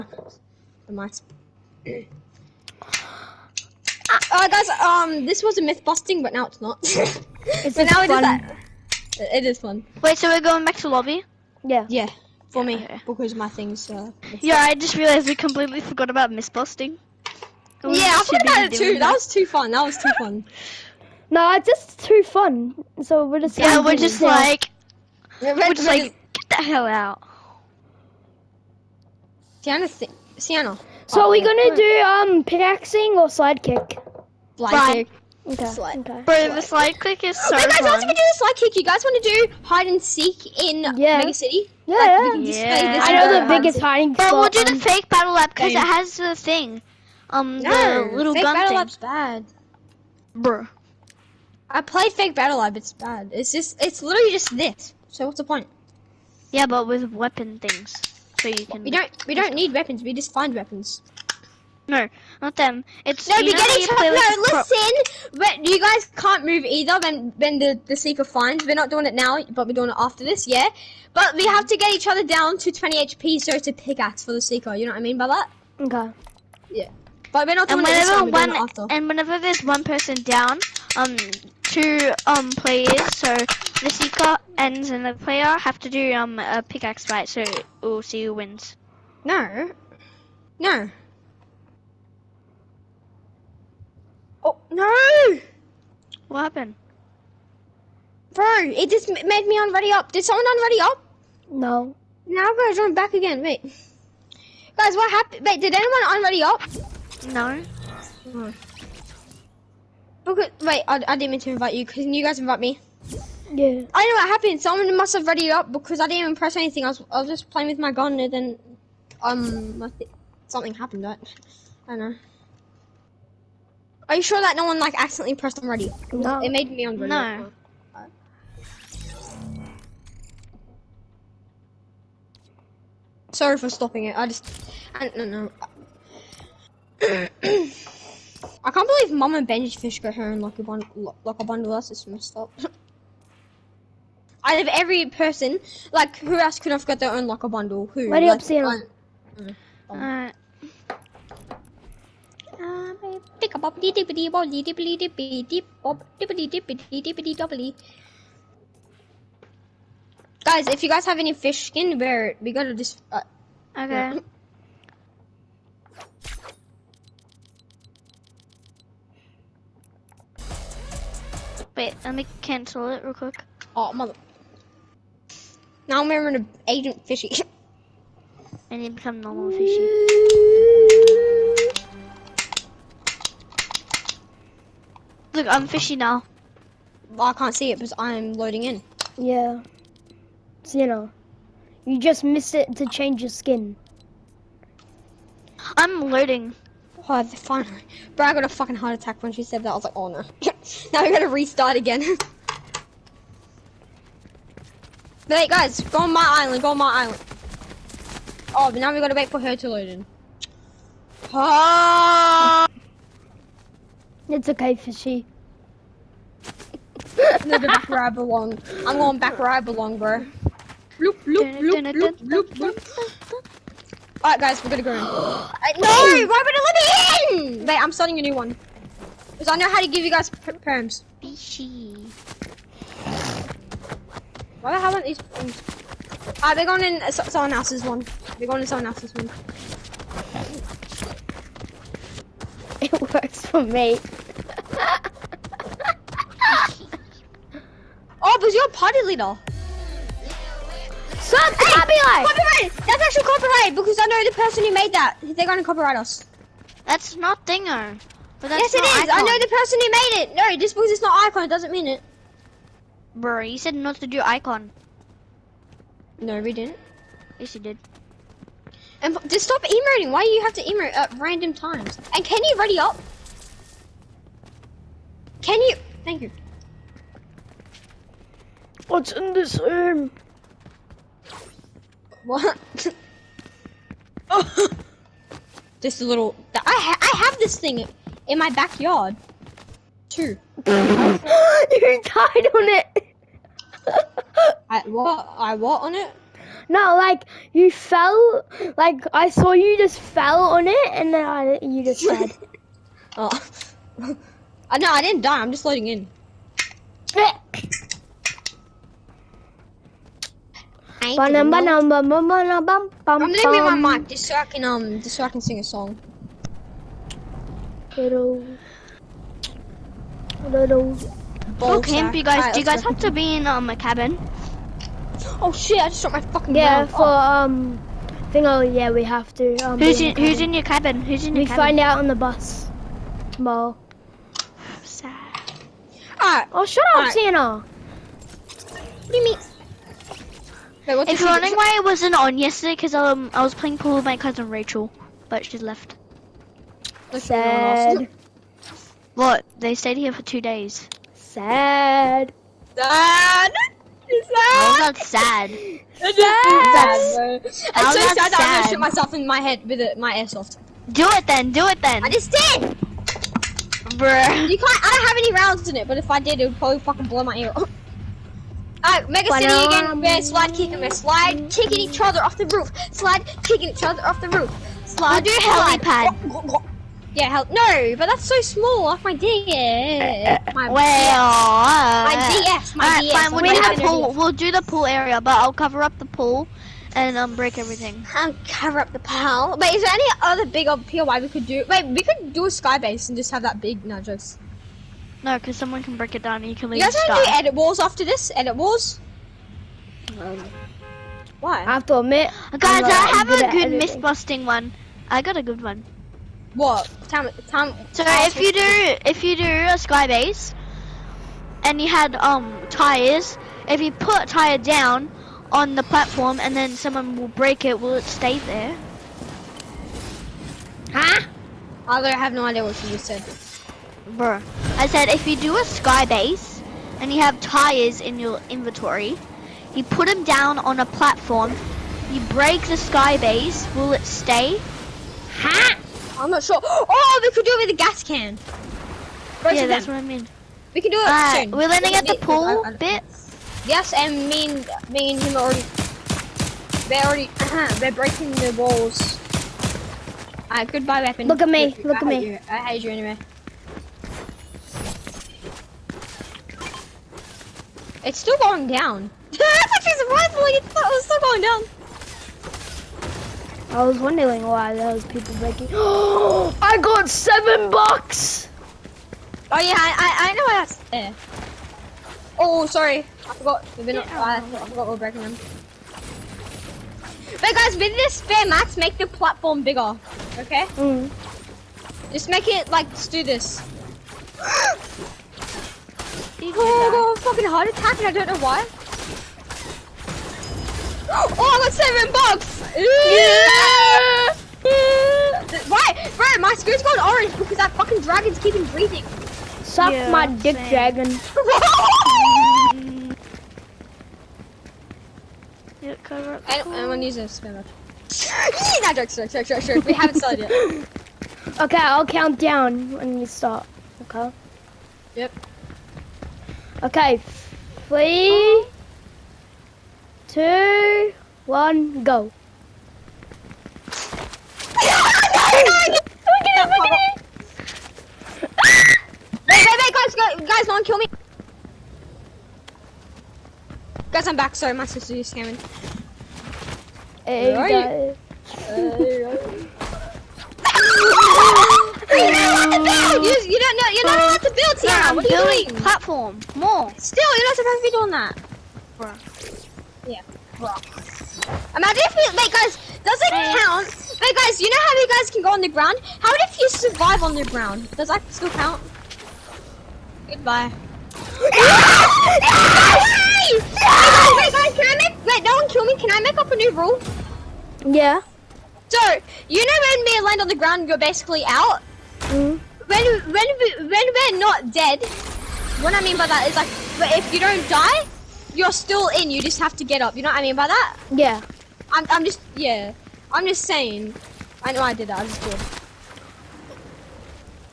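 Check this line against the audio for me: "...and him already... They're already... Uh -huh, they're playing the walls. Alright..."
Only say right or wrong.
wrong.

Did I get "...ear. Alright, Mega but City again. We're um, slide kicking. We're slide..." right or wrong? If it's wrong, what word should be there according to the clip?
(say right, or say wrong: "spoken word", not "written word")
right.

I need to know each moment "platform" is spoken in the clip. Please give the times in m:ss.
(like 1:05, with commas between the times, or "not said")
6:55, 7:10, 7:59, 9:05.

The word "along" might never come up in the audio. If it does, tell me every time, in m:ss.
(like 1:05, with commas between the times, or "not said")
not said.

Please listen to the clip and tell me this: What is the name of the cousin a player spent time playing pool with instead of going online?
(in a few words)
Rachel.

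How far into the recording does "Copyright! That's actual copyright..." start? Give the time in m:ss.
4:12.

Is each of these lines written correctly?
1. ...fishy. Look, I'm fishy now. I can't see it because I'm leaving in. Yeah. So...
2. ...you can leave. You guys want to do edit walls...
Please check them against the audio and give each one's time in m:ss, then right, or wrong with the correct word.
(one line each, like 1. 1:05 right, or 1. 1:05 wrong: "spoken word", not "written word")
1. 2:59 wrong: "loading", not "leaving"
2. 6:36 right.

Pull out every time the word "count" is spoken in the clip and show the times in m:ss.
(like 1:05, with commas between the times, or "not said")
8:32, 9:13, 9:18.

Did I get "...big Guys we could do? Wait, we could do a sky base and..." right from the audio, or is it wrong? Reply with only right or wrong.
wrong.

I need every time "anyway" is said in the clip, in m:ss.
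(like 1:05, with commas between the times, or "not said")
7:32.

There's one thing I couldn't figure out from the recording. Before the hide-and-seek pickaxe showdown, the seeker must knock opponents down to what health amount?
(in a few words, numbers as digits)
20 HP.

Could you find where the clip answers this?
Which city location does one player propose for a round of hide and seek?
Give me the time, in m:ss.
0:41.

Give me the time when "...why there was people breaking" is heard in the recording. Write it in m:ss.
7:44.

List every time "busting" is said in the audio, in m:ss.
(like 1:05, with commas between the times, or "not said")
0:05, 0:16, 6:43.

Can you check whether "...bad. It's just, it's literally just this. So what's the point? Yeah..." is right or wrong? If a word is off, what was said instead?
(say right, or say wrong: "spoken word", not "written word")
right.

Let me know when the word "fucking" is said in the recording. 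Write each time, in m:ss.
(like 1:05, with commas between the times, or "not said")
3:18, 5:26, 6:06, 8:07, 8:17.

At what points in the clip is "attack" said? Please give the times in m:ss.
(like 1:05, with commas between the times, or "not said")
3:18, 8:07.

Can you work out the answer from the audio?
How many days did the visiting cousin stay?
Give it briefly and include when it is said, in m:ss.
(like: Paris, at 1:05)
2, at 5:50.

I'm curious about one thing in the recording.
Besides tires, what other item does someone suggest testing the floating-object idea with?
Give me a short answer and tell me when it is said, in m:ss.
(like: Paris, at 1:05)
gas can, at 7:17.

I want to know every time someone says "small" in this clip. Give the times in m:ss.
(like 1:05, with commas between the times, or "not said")
6:18.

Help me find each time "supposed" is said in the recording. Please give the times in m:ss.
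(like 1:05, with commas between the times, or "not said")
9:07.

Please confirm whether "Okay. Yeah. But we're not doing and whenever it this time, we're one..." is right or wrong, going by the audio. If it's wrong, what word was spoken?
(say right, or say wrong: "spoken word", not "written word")
right.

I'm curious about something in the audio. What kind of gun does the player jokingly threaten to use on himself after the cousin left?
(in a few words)
airsoft.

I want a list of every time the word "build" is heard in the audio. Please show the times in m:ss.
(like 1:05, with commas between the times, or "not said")
9:04.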